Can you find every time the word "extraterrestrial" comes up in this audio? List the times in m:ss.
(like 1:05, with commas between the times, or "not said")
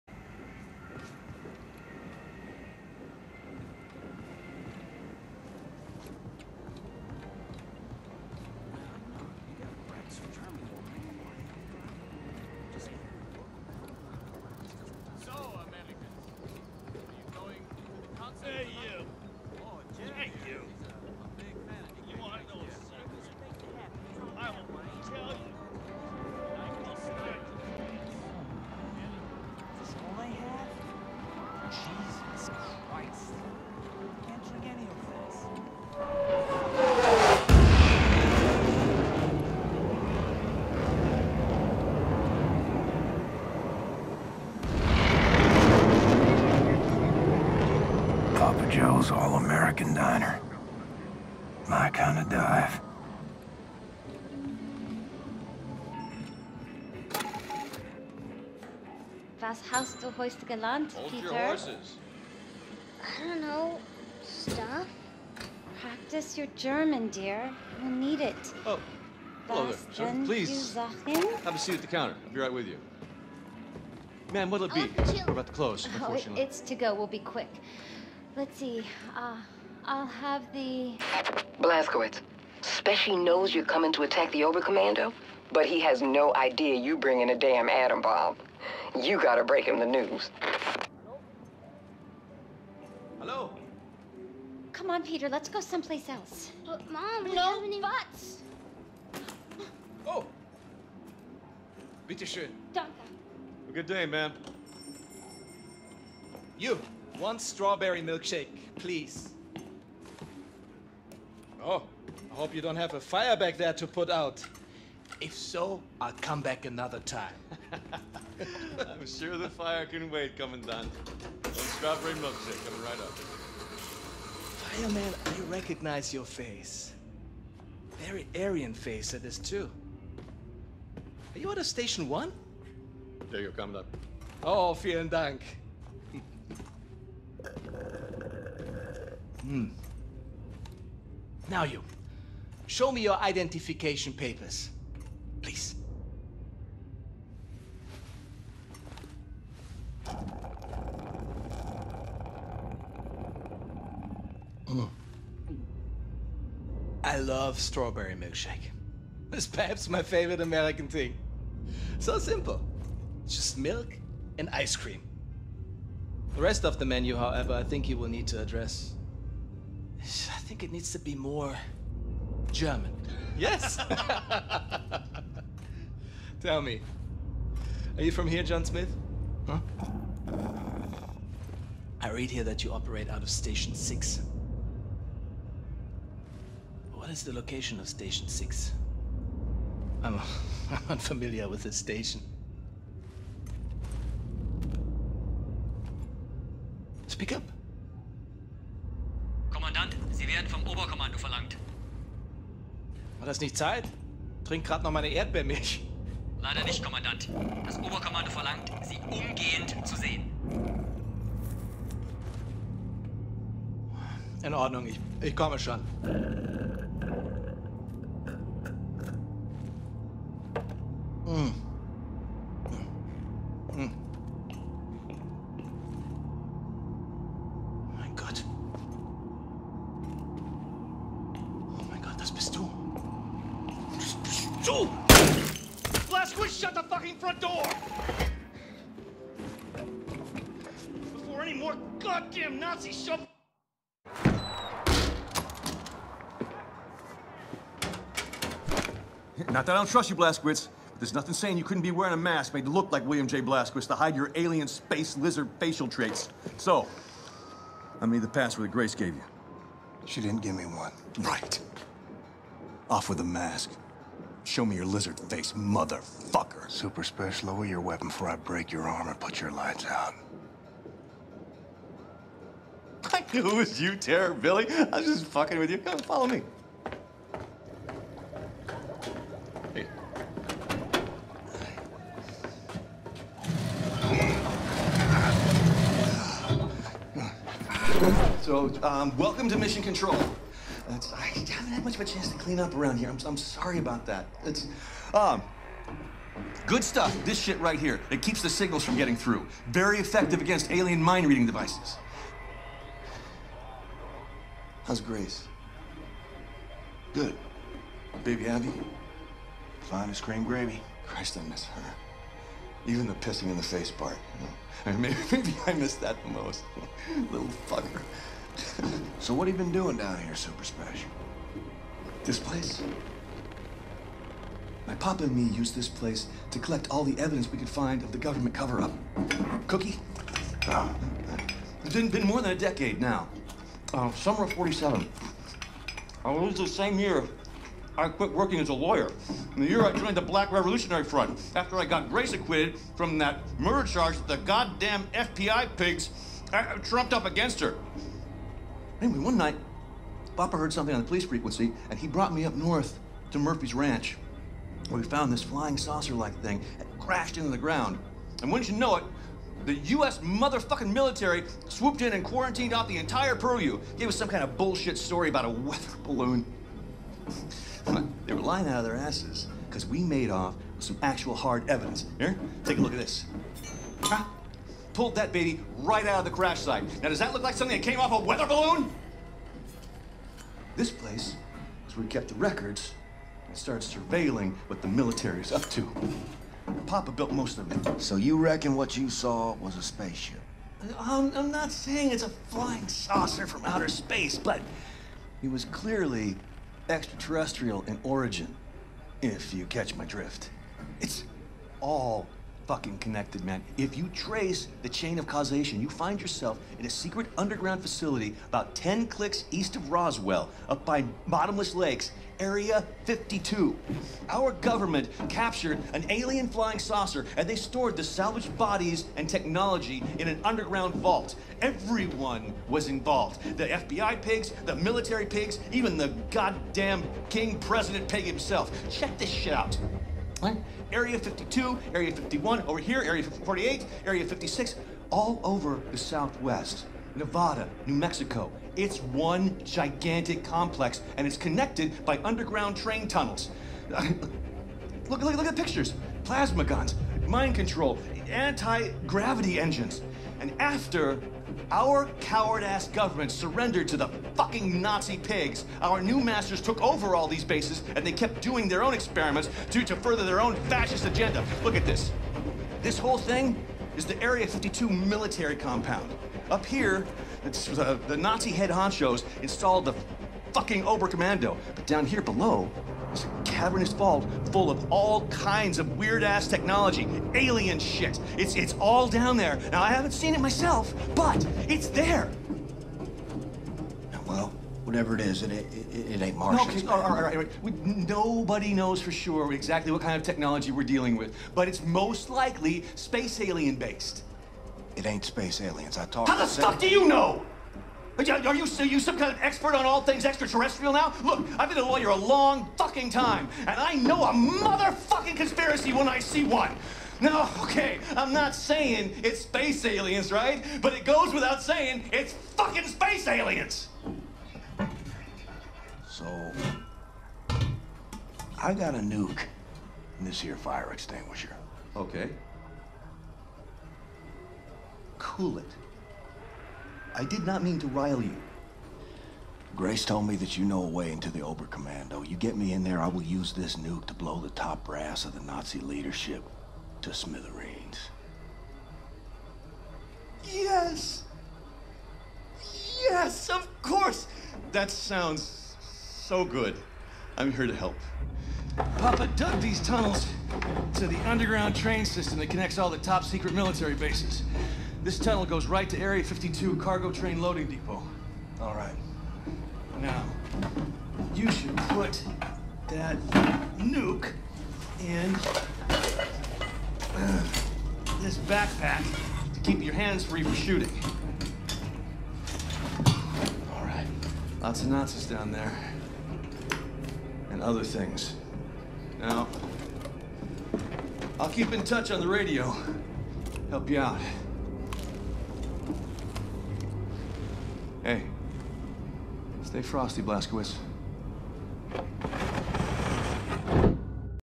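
6:36, 8:20.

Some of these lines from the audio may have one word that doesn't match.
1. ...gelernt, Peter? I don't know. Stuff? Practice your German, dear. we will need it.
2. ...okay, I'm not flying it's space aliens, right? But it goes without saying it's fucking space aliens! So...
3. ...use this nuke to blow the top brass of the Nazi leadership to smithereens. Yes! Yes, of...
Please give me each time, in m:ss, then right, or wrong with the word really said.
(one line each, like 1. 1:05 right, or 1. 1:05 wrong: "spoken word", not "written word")
1. 1:00 right
2. 8:27 wrong: "saying", not "flying"
3. 8:53 right.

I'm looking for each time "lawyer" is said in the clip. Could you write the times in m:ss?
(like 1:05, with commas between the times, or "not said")
5:38, 8:21.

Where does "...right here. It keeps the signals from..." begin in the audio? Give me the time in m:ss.
4:57.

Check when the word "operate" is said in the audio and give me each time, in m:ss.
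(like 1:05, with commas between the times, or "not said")
3:02.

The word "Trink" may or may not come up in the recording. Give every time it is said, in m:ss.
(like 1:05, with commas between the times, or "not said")
3:24.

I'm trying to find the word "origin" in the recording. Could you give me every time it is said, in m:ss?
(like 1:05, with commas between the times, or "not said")
6:38.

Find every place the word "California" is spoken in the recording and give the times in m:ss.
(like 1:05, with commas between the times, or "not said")
not said.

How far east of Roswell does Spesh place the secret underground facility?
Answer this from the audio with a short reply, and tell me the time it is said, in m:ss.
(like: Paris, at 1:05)
10 clicks, at 6:48.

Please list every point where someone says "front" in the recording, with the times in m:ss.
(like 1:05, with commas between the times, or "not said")
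3:57, 5:41.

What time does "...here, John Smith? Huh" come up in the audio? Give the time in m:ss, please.
2:58.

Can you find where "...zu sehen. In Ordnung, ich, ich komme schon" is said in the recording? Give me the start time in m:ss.
3:29.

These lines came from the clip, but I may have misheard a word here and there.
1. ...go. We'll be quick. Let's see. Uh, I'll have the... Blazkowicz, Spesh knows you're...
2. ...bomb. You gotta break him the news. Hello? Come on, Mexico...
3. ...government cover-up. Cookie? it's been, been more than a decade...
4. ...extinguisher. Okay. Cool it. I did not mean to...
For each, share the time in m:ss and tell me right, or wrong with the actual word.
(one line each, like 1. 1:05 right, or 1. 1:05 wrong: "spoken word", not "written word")
1. 1:16 right
2. 1:28 wrong: "Peter", not "Mexico"
3. 5:28 right
4. 8:40 right.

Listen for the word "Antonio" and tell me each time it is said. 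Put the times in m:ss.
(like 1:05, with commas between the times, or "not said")
not said.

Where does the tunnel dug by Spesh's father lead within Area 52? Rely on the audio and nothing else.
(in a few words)
Cargo Train Loading Depot.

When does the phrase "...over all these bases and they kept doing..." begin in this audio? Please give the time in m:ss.
7:36.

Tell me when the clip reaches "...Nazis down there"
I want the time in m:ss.
9:34.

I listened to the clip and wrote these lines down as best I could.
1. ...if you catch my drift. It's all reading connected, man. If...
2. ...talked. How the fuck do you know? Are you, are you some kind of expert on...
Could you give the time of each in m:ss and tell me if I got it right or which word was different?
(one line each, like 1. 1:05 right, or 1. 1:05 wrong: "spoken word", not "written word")
1. 6:39 wrong: "fucking", not "reading"
2. 8:16 right.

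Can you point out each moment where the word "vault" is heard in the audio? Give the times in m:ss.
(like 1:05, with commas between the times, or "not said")
7:00, 7:53.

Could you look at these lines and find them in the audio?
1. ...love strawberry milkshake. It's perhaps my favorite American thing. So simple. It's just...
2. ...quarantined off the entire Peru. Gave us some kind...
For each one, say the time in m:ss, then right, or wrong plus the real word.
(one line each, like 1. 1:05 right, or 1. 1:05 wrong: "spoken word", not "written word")
1. 2:37 right
2. 6:02 right.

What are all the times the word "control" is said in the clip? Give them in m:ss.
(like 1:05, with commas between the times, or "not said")
4:49, 7:27.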